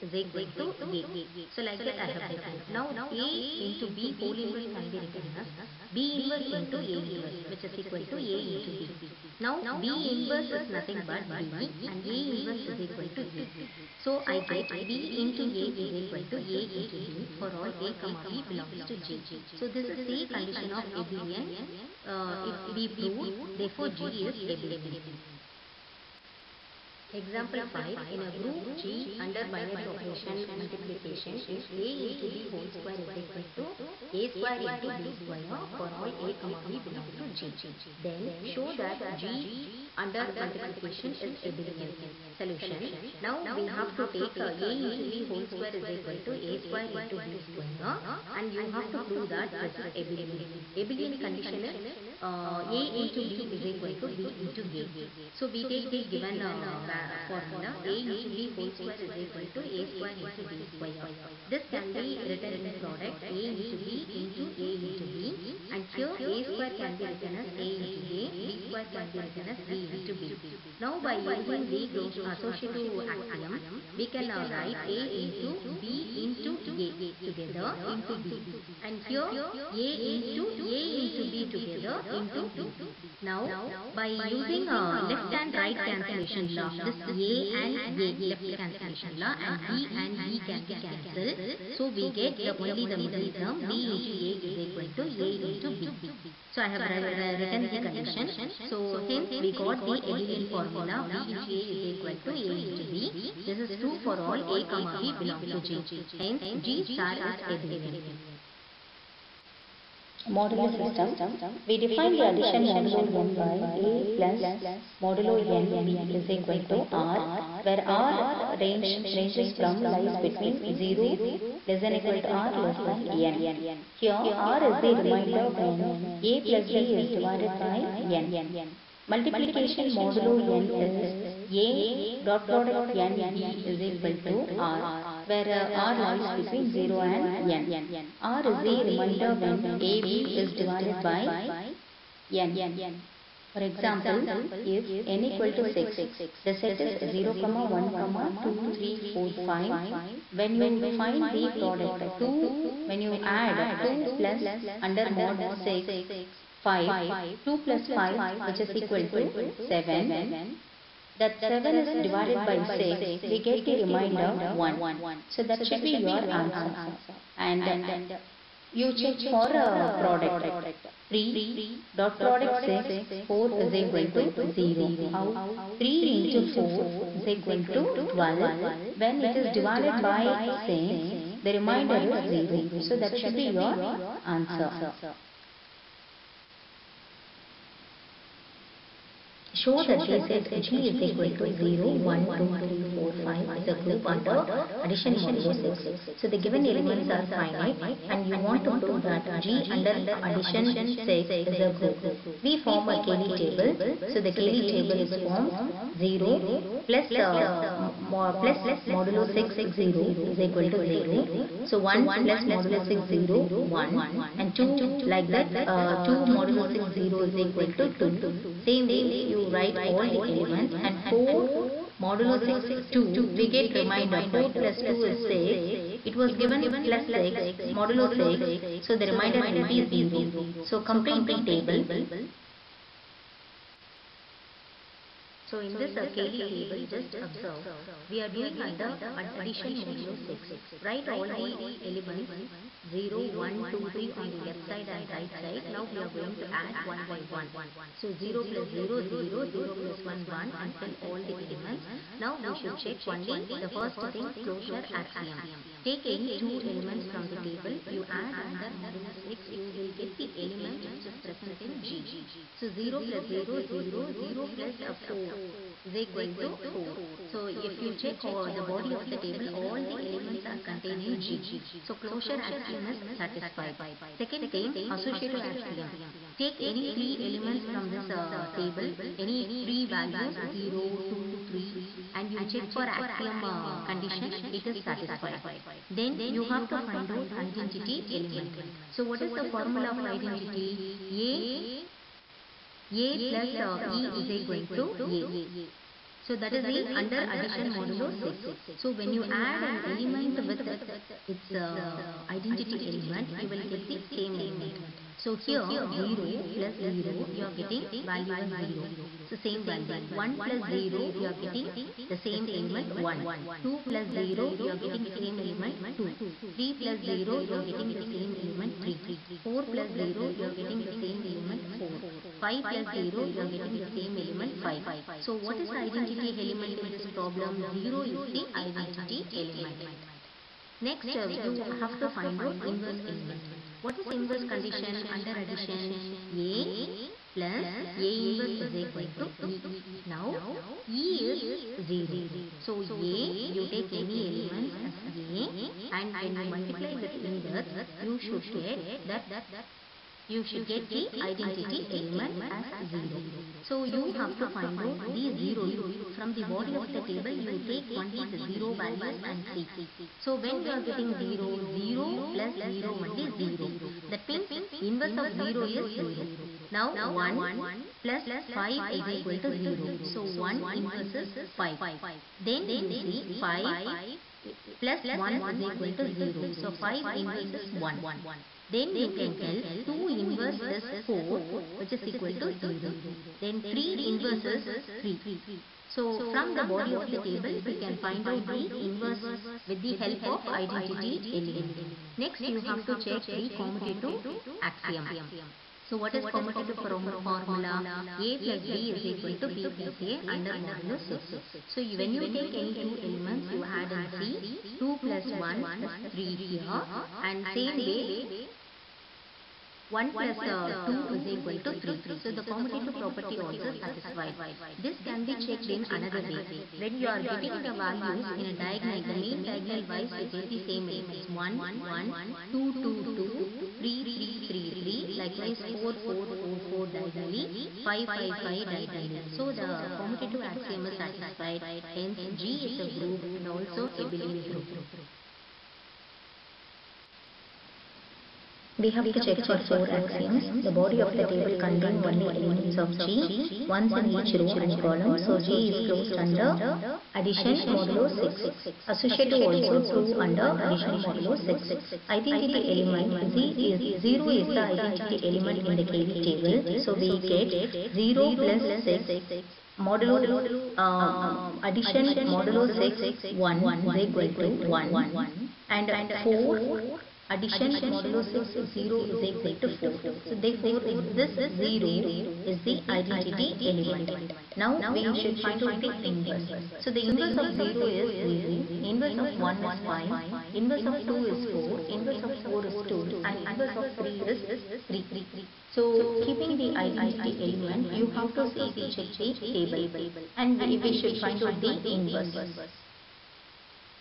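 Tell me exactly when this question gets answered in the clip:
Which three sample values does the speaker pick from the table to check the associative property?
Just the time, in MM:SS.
04:40.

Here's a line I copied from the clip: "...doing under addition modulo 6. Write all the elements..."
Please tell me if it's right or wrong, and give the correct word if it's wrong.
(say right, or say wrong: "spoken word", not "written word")
right.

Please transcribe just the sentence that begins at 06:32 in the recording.
Next you have to check the commutative axiom.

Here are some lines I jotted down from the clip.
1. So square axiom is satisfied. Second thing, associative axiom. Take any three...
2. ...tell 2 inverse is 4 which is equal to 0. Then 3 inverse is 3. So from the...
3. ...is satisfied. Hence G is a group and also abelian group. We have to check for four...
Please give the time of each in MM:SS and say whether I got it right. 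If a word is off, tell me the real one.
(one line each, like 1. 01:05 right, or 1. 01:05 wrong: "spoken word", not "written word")
1. 04:31 wrong: "closure", not "square"
2. 06:19 right
3. 07:10 right.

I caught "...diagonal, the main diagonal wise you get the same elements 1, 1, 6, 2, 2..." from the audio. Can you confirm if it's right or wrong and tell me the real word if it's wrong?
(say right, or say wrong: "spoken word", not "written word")
wrong: "2", not "6".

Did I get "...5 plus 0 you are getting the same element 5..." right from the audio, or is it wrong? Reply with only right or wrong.
right.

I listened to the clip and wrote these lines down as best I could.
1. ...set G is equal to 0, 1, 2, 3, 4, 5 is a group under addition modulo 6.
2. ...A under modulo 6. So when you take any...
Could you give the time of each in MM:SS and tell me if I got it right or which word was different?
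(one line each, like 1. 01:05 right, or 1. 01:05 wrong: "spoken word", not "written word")
1. 03:10 right
2. 06:40 right.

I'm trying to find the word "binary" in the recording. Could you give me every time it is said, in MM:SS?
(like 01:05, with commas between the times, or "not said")
00:29.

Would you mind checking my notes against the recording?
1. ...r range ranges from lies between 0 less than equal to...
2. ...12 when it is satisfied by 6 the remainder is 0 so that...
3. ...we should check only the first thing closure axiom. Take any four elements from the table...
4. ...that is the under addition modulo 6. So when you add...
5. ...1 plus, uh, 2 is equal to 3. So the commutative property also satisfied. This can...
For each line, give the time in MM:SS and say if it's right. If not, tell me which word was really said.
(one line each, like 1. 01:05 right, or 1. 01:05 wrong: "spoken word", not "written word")
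1. 01:57 right
2. 02:58 wrong: "divided", not "satisfied"
3. 04:12 wrong: "two", not "four"
4. 04:56 right
5. 06:49 right.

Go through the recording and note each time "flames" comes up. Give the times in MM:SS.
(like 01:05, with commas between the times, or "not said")
not said.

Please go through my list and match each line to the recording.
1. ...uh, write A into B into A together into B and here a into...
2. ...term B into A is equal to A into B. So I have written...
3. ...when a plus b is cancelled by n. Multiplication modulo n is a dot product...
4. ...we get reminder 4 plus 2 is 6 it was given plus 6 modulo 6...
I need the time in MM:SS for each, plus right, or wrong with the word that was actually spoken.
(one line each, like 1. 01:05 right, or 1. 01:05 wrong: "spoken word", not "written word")
1. 01:14 right
2. 01:33 right
3. 02:05 wrong: "divided", not "cancelled"
4. 03:43 right.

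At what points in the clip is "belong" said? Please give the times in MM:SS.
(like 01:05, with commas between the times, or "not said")
00:18, 00:36, 01:45.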